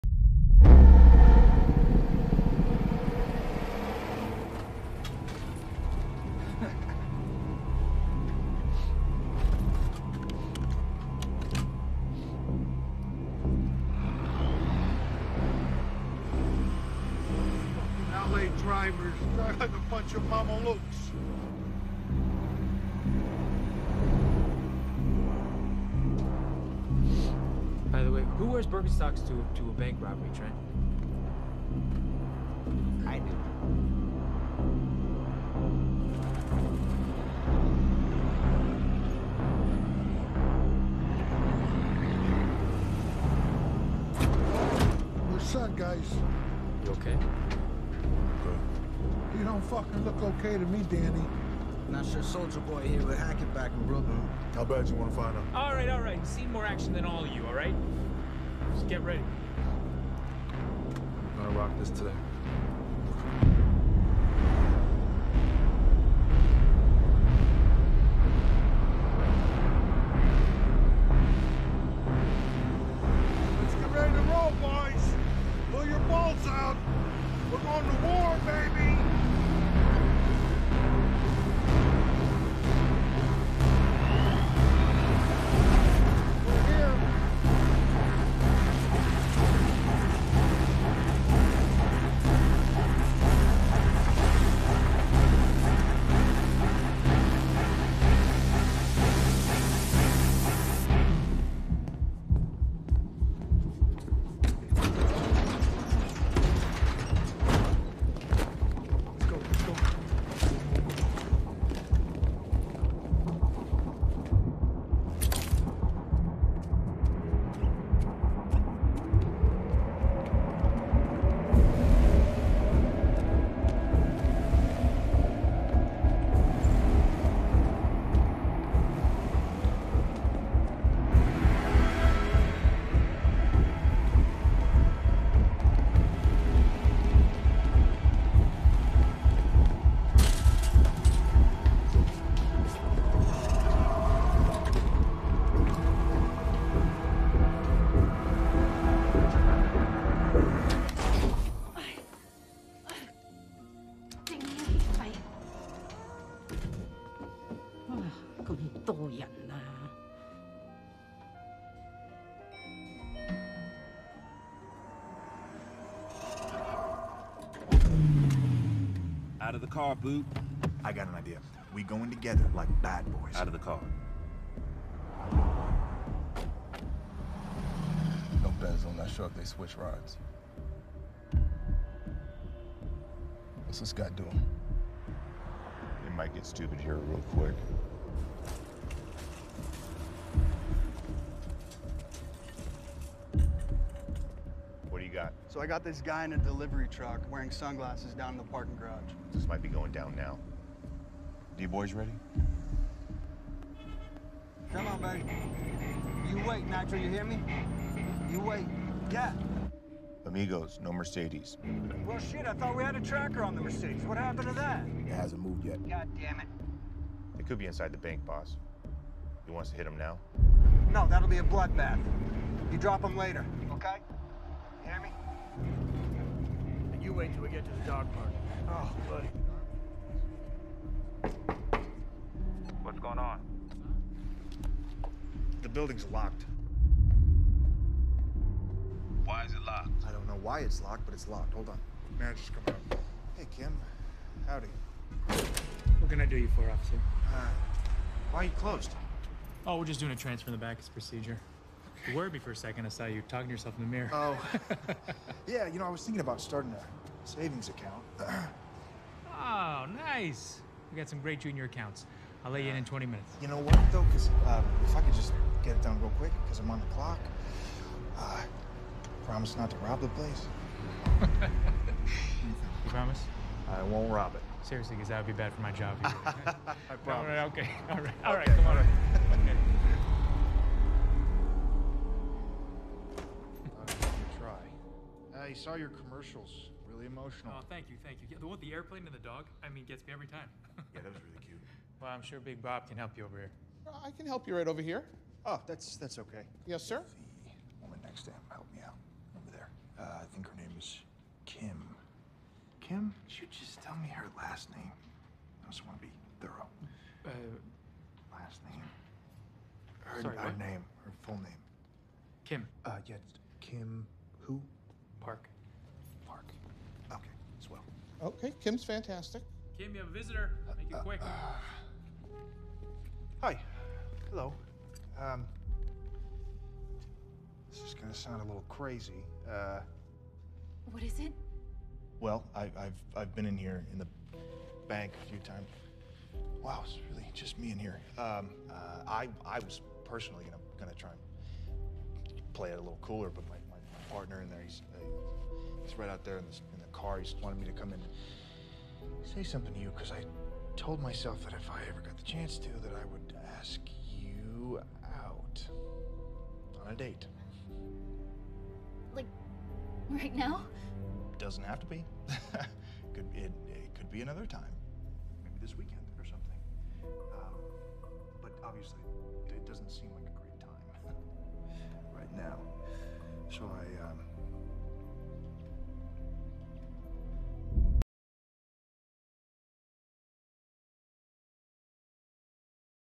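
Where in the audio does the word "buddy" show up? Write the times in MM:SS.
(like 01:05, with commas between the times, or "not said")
03:25, 03:49.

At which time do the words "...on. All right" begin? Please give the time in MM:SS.
04:38.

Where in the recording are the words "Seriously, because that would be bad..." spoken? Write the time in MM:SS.
04:34.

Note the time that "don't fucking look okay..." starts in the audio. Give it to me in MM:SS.
00:49.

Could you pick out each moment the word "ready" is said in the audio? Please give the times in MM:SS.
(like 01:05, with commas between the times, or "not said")
00:59, 01:13, 03:21.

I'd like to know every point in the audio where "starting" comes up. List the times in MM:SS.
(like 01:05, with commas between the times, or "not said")
04:16.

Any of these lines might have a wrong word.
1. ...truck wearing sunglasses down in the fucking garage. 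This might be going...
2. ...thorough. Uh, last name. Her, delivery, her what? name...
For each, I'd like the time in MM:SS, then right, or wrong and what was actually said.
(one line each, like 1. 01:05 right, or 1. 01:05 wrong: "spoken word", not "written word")
1. 03:16 wrong: "parking", not "fucking"
2. 05:06 wrong: "sorry", not "delivery".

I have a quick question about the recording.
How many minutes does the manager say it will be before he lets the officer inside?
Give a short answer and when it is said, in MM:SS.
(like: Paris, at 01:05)
20, at 04:22.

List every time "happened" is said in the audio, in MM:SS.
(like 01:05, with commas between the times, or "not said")
03:34.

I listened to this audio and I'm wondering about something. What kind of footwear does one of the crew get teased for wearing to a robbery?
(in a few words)
Birkenstocks.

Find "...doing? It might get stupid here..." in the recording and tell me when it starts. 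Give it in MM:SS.
03:04.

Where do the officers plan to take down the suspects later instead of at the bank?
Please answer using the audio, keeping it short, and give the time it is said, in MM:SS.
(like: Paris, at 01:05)
the dog park, at 03:47.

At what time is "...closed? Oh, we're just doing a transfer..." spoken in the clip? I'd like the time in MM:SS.
04:08.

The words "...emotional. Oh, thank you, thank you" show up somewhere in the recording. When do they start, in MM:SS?
04:47.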